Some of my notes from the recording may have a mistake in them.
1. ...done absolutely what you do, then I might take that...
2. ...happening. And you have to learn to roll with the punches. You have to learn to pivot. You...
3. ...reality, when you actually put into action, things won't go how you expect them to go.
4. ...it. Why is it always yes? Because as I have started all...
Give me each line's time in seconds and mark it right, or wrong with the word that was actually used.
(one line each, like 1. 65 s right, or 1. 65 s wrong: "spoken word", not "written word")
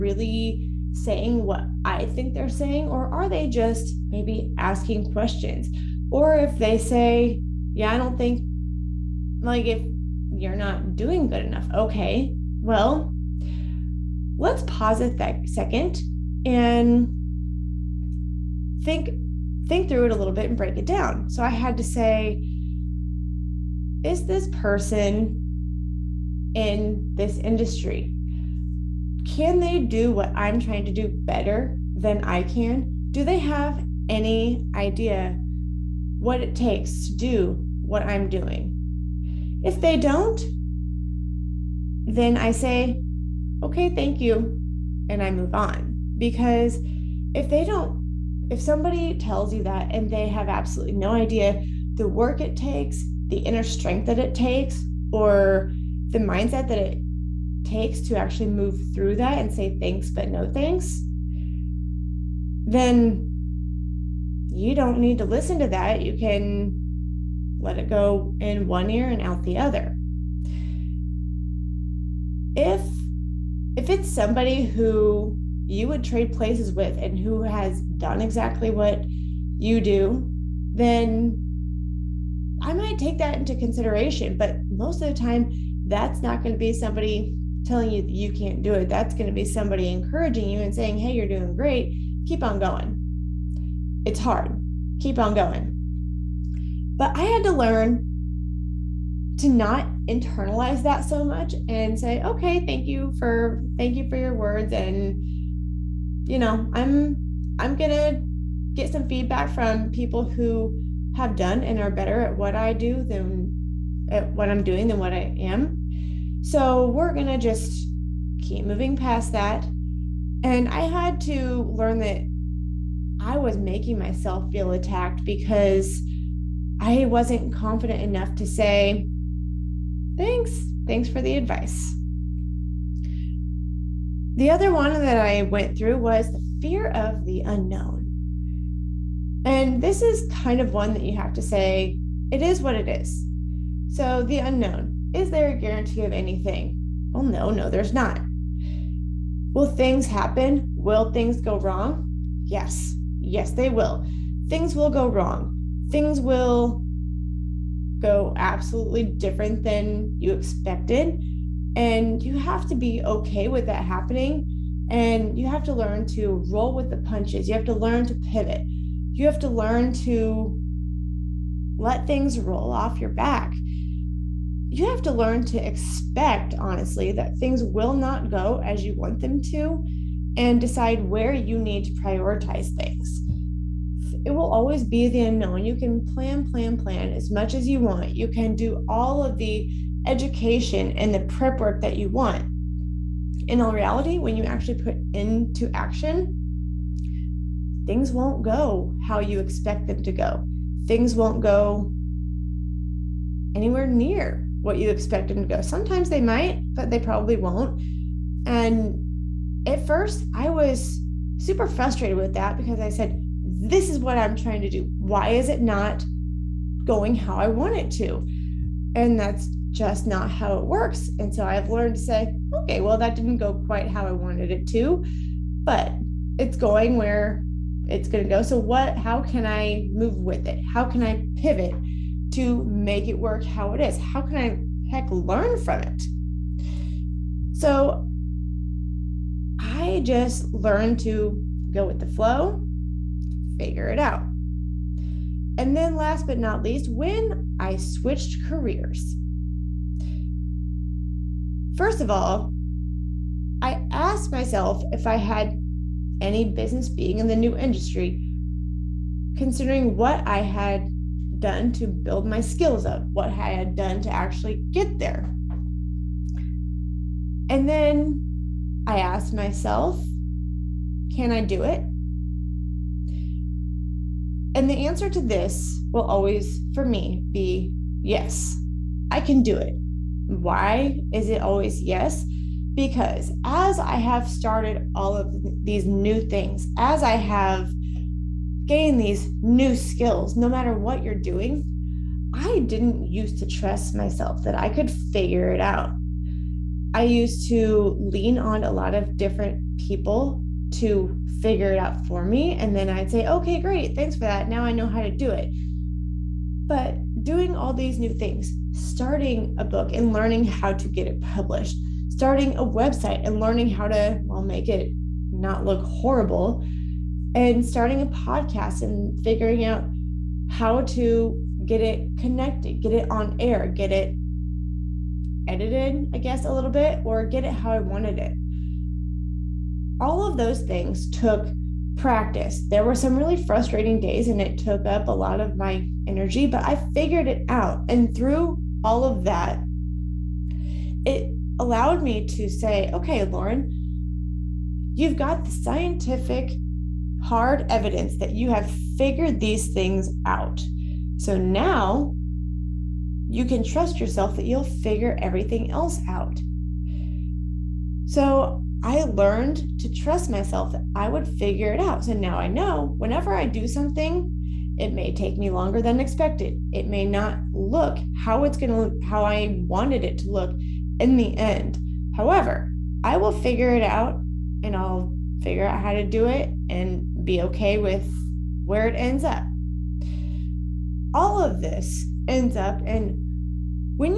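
1. 77 s wrong: "exactly", not "absolutely"
2. 163 s right
3. 193 s right
4. 279 s right.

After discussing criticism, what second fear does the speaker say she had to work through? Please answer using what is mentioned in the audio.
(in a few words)
Fear of the unknown.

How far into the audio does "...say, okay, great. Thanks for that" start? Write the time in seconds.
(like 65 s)
303 s.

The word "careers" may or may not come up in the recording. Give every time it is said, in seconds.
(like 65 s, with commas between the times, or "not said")
248 s.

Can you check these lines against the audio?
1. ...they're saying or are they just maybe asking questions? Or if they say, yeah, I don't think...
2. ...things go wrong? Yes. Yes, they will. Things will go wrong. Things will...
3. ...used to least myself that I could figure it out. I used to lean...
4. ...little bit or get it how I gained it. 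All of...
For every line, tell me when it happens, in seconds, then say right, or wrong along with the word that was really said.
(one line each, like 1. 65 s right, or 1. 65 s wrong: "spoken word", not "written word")
1. 2 s right
2. 151 s right
3. 293 s wrong: "trust", not "least"
4. 326 s wrong: "wanted", not "gained".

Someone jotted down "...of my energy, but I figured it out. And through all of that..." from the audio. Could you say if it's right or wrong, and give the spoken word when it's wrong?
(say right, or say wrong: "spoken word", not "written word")
right.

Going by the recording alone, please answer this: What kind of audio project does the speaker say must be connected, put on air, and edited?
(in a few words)
A podcast.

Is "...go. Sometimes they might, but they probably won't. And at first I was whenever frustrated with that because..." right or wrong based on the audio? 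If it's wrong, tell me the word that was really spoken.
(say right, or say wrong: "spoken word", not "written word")
wrong: "super", not "whenever".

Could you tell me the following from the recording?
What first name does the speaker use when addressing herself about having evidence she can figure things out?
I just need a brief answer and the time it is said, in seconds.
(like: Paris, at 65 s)
Lauren, at 343 s.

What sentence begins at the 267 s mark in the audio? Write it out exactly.
And then I asked myself, can I do it?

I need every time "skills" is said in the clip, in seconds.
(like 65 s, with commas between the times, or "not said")
262 s, 289 s.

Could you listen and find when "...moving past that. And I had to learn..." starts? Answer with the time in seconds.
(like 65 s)
118 s.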